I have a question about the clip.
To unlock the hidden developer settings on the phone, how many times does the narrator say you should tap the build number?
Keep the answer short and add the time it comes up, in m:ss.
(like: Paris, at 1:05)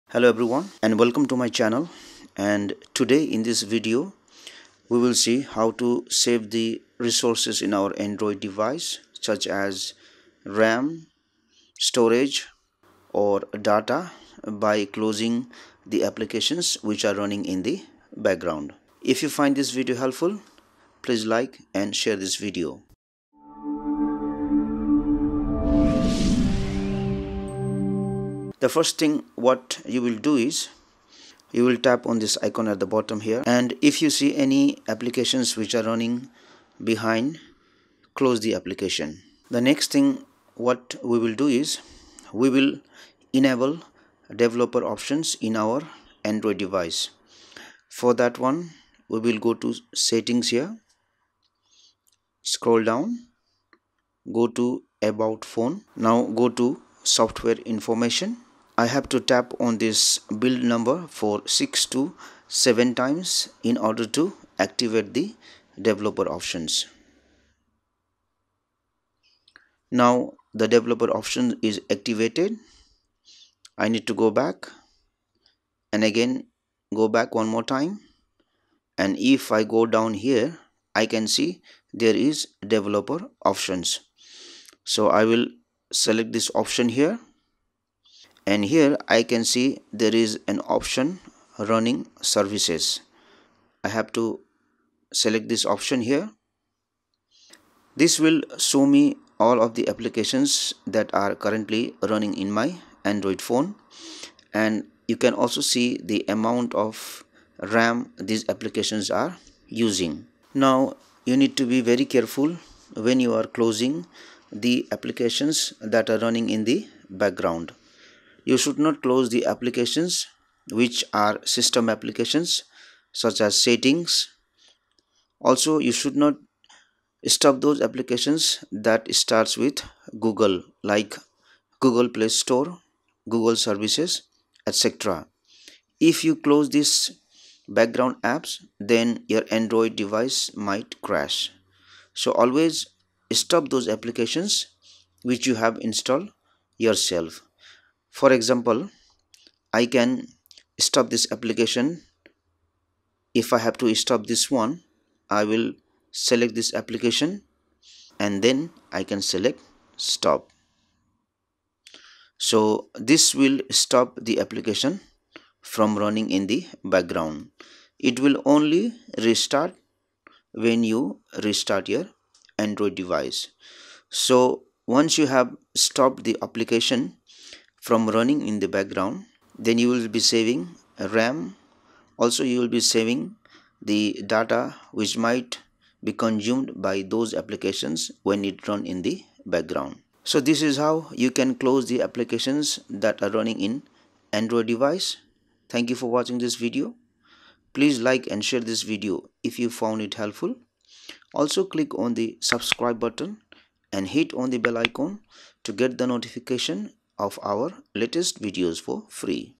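6 to 7, at 1:01.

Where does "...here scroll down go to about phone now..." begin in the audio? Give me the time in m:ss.
0:50.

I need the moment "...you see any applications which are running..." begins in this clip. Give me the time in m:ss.
0:34.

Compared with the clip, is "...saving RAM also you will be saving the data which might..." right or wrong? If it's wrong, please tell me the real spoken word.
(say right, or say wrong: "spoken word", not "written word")
right.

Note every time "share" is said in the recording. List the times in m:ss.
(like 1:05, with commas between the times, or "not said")
0:21, 3:18.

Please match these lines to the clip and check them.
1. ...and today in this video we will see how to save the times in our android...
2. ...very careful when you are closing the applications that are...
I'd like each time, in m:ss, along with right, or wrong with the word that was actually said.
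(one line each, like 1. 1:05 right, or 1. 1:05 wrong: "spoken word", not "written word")
1. 0:02 wrong: "resources", not "times"
2. 1:51 right.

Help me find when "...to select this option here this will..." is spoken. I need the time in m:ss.
1:34.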